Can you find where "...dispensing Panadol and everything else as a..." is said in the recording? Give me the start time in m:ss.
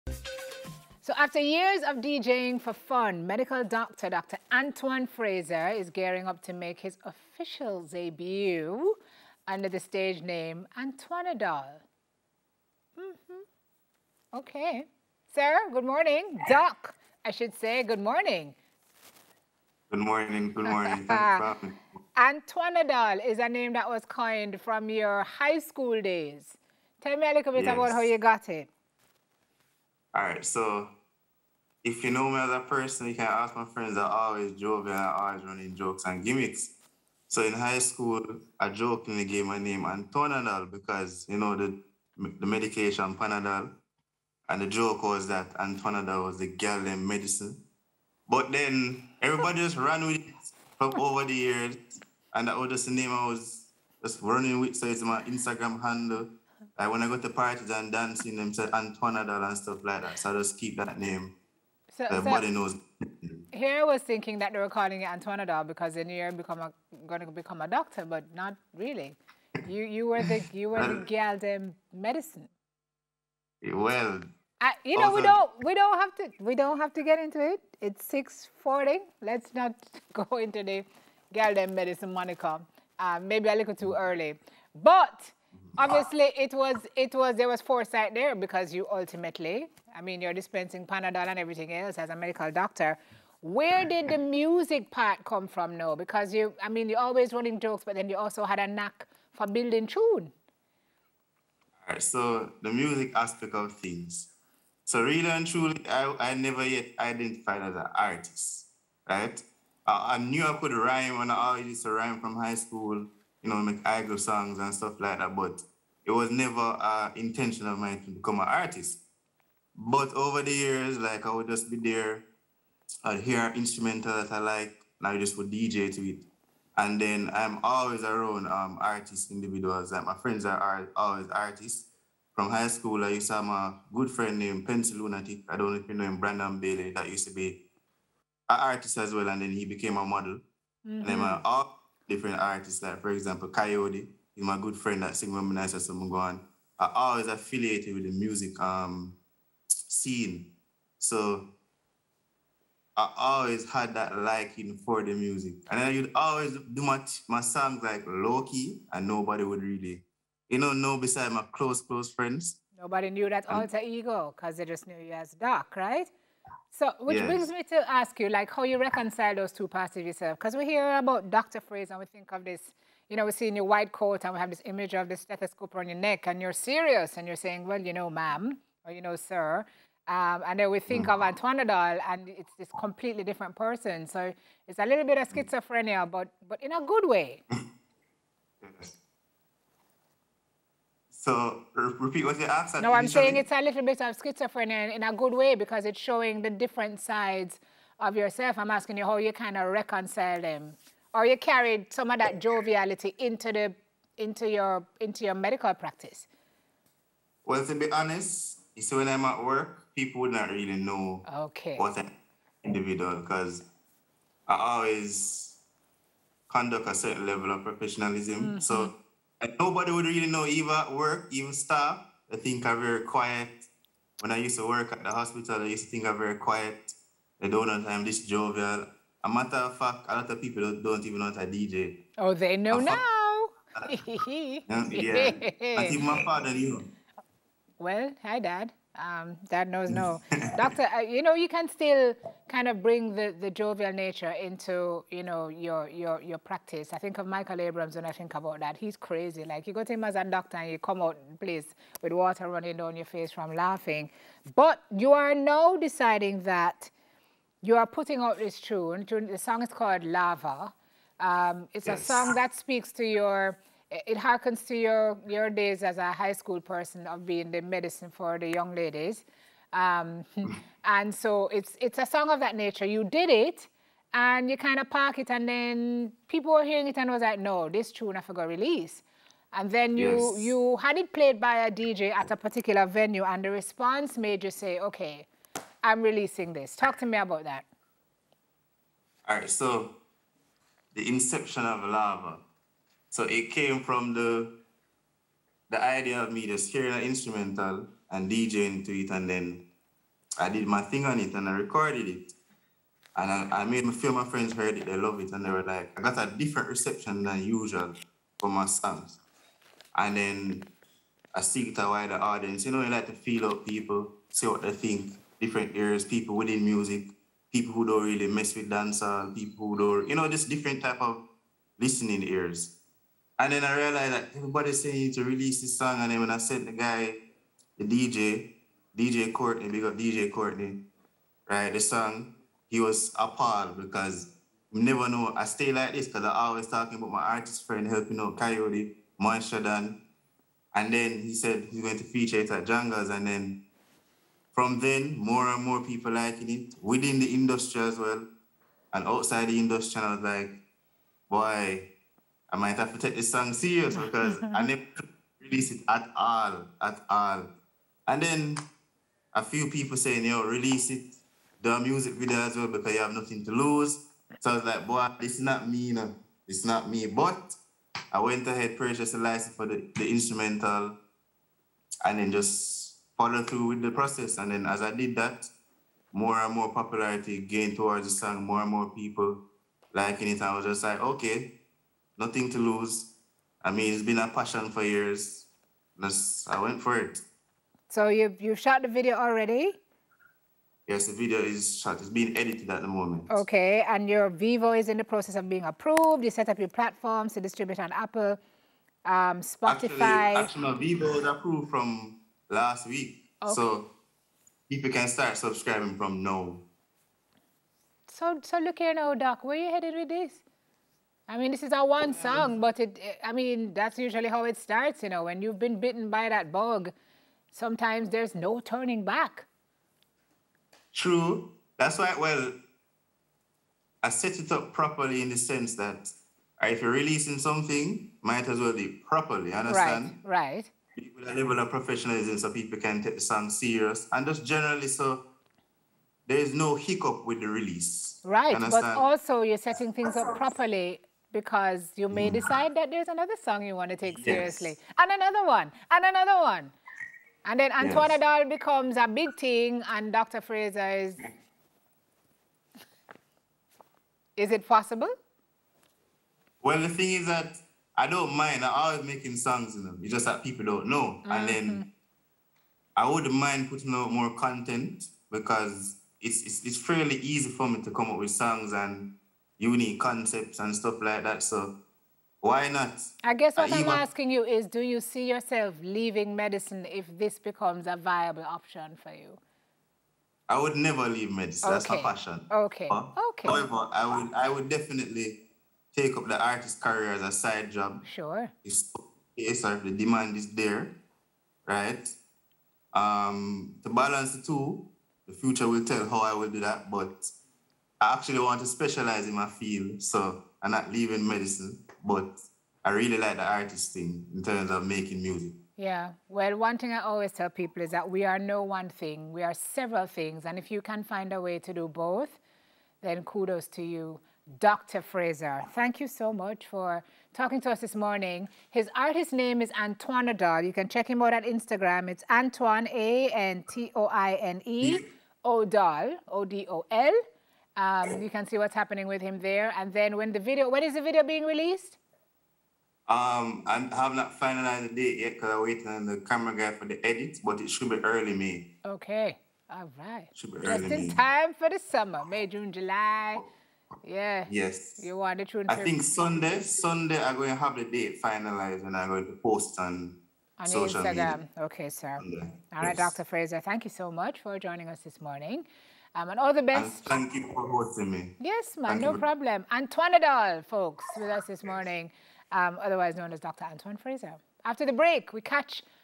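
1:30.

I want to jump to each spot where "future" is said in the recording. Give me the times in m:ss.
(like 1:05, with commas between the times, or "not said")
8:15.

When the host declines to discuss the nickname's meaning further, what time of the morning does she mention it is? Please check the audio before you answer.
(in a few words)
6:40.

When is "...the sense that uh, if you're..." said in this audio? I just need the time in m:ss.
7:05.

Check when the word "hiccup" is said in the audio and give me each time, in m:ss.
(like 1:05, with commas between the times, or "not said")
7:16.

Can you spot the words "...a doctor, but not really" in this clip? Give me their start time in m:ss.
1:07.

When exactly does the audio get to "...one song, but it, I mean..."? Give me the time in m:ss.
6:51.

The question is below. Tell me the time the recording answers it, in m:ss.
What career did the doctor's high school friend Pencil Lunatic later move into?
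2:20.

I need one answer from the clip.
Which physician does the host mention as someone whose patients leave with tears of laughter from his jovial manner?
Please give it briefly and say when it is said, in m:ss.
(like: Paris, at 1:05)
Michael Abrams, at 4:07.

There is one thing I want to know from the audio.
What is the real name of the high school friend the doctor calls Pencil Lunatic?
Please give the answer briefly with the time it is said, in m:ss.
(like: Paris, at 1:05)
Brandon Bailey, at 2:16.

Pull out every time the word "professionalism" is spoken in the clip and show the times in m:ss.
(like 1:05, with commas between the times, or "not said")
3:37, 7:11.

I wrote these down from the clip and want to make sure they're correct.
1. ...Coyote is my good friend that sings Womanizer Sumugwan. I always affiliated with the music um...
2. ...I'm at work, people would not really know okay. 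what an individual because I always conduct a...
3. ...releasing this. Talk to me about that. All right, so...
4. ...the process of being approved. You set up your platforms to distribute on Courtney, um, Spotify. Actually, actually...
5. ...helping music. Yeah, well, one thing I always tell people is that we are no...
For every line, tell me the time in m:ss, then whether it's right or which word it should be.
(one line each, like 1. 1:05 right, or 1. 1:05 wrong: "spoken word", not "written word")
1. 2:23 right
2. 3:29 right
3. 4:46 right
4. 6:34 wrong: "Apple", not "Courtney"
5. 8:24 wrong: "making", not "helping".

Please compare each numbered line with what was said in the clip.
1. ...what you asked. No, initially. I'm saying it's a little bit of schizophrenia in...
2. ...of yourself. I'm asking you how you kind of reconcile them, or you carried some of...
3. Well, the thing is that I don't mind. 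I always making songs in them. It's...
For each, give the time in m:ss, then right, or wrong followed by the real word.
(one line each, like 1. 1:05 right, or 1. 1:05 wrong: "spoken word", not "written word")
1. 3:12 right
2. 3:17 right
3. 7:36 right.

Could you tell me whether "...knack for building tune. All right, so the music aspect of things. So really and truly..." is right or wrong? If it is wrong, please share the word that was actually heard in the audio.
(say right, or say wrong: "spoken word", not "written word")
right.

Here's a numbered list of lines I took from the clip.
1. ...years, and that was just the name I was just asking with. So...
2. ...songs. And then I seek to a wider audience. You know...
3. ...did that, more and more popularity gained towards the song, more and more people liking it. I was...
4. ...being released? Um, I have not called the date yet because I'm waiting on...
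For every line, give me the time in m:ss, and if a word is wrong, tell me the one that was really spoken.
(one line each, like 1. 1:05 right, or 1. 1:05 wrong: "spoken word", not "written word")
1. 0:51 wrong: "running", not "asking"
2. 5:08 right
3. 6:14 right
4. 8:51 wrong: "finalized", not "called".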